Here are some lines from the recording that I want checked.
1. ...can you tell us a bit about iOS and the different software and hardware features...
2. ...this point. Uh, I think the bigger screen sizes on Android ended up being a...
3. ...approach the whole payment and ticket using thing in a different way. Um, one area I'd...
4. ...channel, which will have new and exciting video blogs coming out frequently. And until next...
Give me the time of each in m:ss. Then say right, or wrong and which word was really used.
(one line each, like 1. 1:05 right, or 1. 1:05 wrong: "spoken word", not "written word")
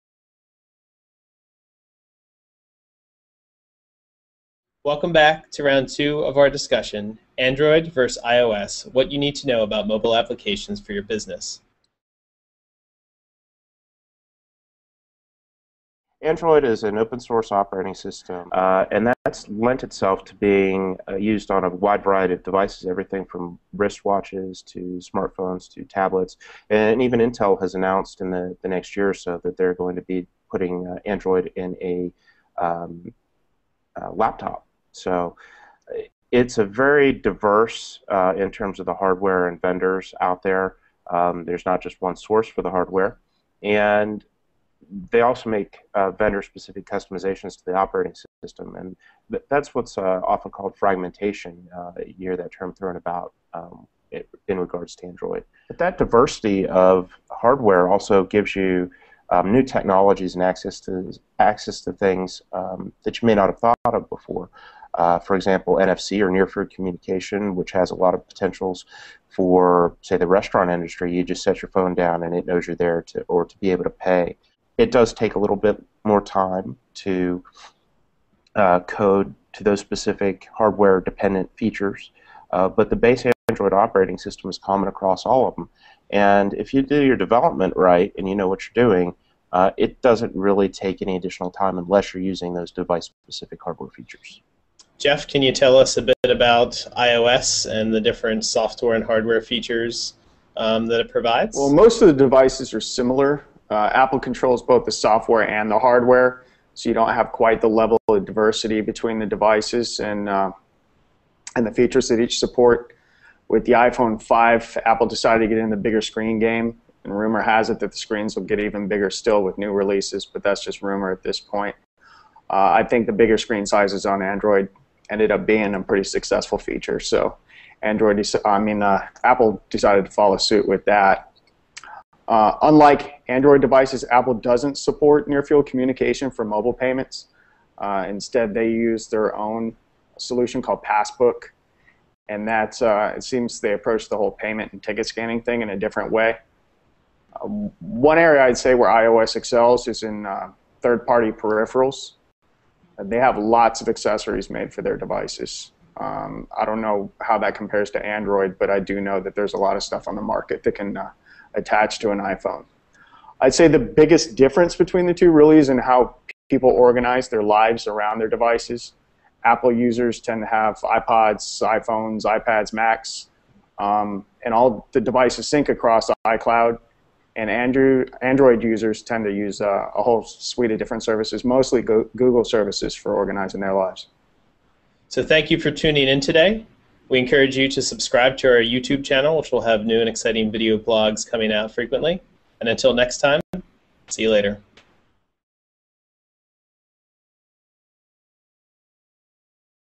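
1. 1:35 right
2. 2:01 right
3. 2:23 wrong: "scanning", not "using"
4. 3:09 right.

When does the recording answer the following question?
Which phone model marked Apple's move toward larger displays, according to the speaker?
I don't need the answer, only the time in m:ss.
1:53.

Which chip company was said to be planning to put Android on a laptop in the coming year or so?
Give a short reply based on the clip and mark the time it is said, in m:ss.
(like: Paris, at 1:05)
Intel, at 0:27.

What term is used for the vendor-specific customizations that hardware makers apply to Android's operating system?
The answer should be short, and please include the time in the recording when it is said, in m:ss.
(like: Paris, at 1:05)
fragmentation, at 0:50.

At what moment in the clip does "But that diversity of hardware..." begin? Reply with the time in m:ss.
0:55.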